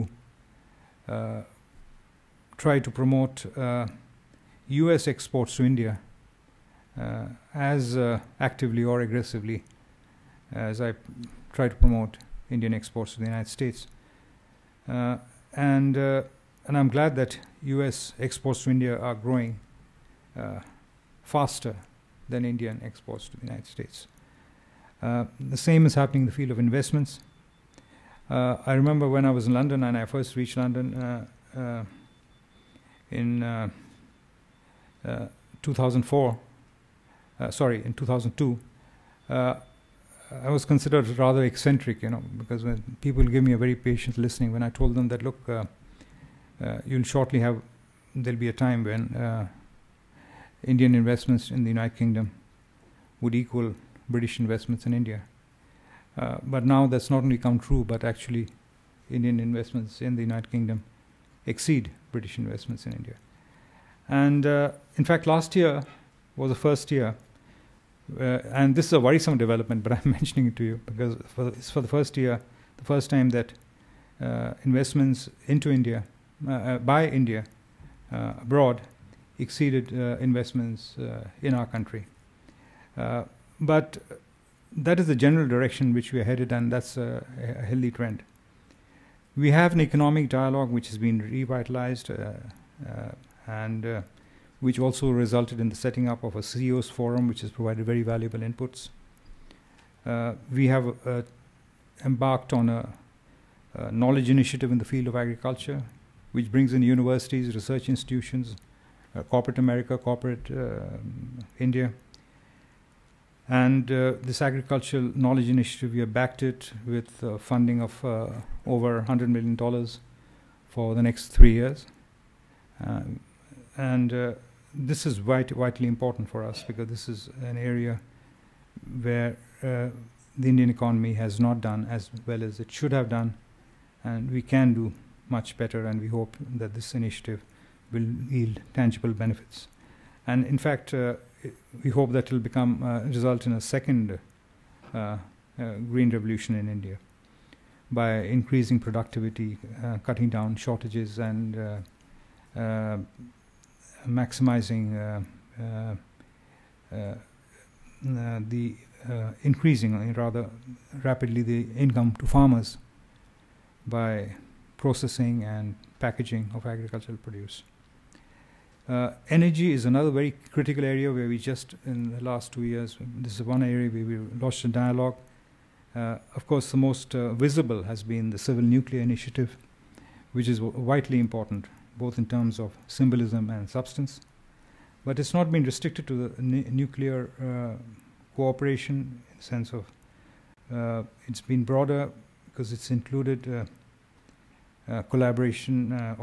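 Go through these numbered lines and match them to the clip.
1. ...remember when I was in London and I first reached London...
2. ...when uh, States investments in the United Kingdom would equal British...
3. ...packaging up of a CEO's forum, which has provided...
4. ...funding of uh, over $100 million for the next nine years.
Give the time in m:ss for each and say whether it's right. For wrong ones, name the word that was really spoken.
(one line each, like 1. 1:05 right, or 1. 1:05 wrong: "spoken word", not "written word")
1. 0:28 right
2. 0:48 wrong: "Indian", not "States"
3. 1:35 wrong: "setting", not "packaging"
4. 1:57 wrong: "three", not "nine".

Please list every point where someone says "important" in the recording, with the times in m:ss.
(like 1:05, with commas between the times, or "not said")
2:05, 3:01.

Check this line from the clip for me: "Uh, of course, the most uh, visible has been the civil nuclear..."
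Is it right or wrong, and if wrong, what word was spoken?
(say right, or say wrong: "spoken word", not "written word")
right.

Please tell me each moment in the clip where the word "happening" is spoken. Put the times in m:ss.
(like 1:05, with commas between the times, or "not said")
0:25.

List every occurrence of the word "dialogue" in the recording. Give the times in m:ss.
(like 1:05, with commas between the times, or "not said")
1:30, 2:54.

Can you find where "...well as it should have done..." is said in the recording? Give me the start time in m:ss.
2:12.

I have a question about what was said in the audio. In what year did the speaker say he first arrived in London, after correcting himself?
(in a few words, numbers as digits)
2002.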